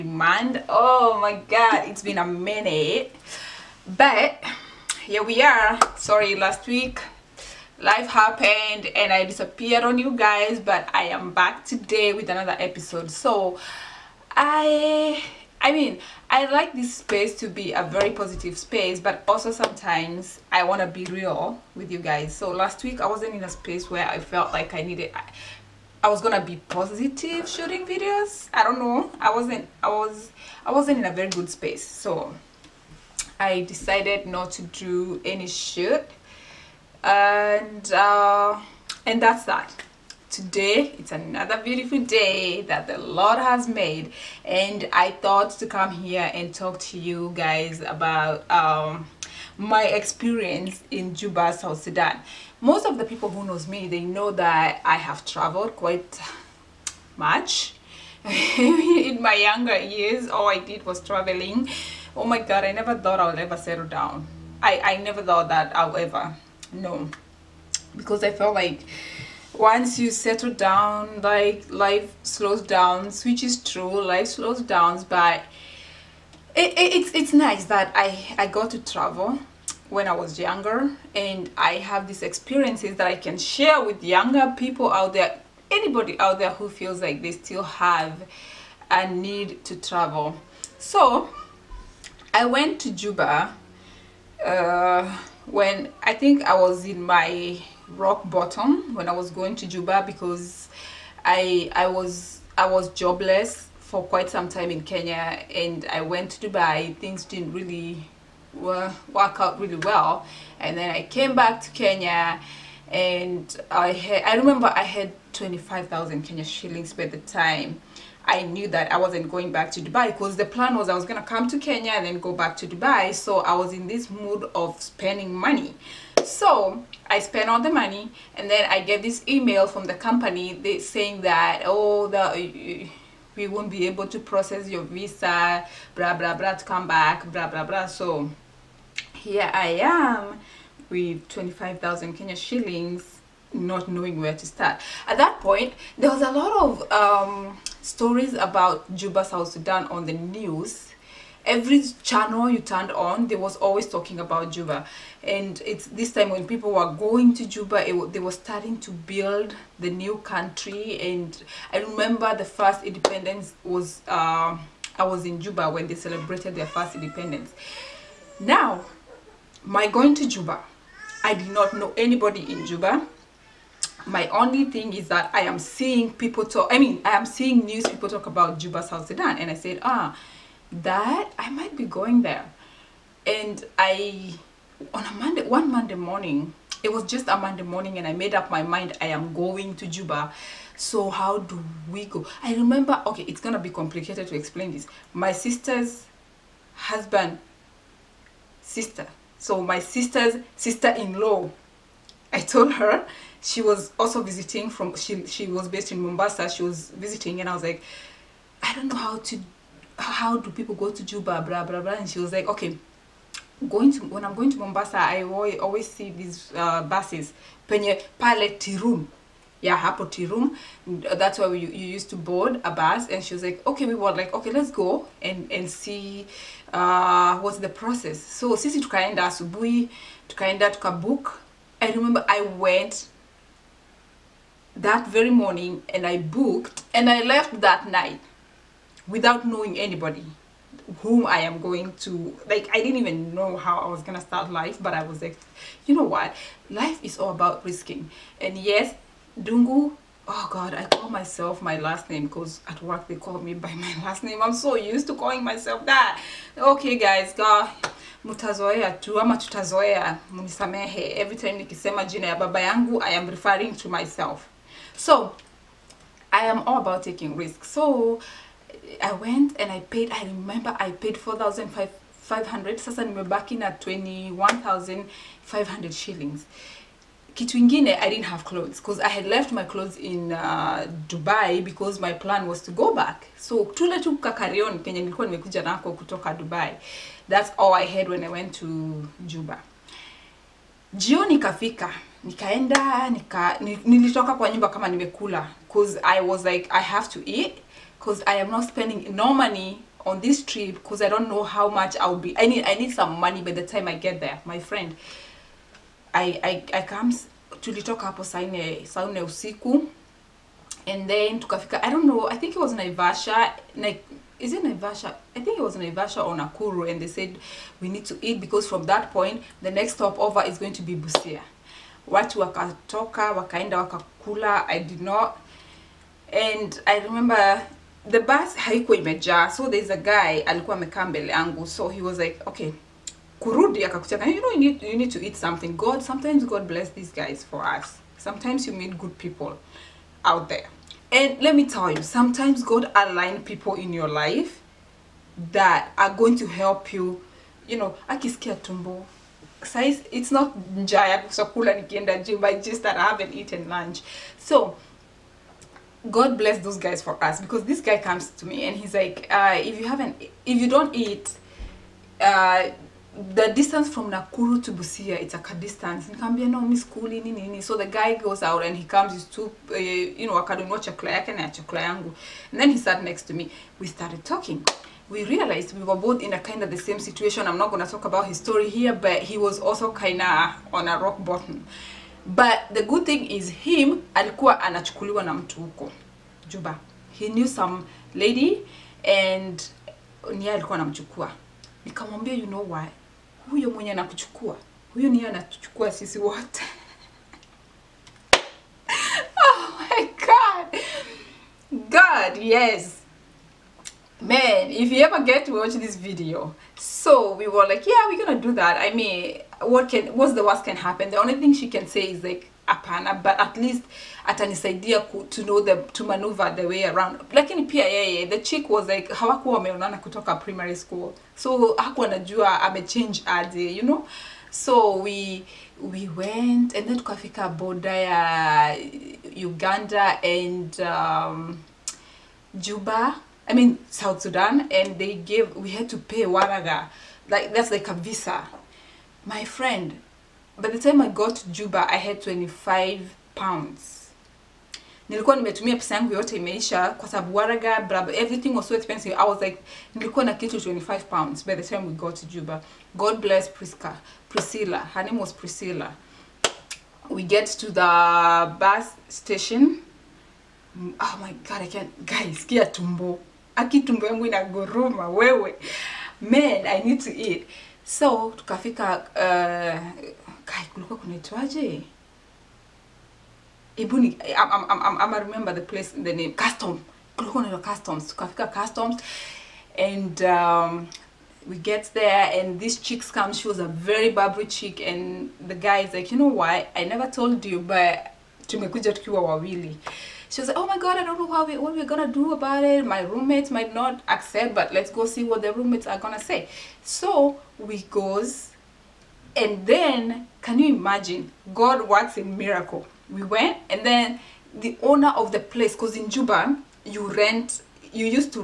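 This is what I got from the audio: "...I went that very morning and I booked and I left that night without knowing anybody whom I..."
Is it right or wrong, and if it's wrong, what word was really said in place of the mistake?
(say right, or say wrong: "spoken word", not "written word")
right.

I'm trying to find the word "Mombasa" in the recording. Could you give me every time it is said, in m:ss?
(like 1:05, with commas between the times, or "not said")
3:25, 3:34.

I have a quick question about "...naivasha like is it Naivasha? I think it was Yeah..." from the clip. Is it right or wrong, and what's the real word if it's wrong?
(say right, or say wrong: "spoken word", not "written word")
wrong: "Naivasha", not "Yeah".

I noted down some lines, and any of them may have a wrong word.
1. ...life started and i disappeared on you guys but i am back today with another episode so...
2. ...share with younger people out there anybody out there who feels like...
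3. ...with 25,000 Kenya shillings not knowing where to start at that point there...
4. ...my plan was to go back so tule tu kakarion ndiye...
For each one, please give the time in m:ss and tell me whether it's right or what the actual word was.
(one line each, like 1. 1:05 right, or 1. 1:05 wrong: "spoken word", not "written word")
1. 0:07 wrong: "happened", not "started"
2. 1:23 right
3. 2:20 right
4. 4:41 wrong: "kenye", not "ndiye".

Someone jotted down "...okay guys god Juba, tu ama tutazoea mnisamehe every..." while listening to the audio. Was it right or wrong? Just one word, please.
wrong.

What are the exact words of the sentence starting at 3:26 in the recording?
She was visiting, and I was like, I don't know how to how do people go to Juba, blah blah blah.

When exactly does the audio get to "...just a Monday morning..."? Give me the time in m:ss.
3:07.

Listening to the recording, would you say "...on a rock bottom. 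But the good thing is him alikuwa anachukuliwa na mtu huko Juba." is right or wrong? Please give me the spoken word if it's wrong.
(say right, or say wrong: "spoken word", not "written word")
right.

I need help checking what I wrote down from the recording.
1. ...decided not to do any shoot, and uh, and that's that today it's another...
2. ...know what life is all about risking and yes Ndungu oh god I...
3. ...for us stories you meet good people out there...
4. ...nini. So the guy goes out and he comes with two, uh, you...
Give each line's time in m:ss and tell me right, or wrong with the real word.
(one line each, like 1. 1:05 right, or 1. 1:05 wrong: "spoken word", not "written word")
1. 0:33 right
2. 4:05 right
3. 5:37 wrong: "sometimes", not "stories"
4. 6:07 right.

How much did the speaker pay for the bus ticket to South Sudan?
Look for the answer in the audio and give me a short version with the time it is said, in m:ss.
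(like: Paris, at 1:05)
4,500, at 4:31.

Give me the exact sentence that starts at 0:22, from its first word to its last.
So last week I wasn't in a space where I felt like I needed, I, I was gonna be positive shooting videos.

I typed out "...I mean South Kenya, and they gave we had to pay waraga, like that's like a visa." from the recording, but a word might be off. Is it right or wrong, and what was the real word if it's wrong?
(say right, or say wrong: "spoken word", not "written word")
wrong: "Sudan", not "Kenya".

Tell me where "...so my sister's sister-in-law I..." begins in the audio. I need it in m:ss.
3:19.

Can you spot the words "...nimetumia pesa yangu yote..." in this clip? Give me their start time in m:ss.
7:25.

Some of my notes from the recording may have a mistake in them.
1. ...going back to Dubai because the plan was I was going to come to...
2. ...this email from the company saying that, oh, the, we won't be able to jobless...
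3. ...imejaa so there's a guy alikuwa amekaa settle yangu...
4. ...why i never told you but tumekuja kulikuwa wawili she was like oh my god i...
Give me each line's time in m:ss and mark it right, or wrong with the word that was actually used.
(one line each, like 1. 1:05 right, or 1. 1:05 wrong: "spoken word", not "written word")
1. 1:59 right
2. 2:09 wrong: "process", not "jobless"
3. 5:28 wrong: "mbele", not "settle"
4. 8:06 wrong: "tukiwa", not "kulikuwa".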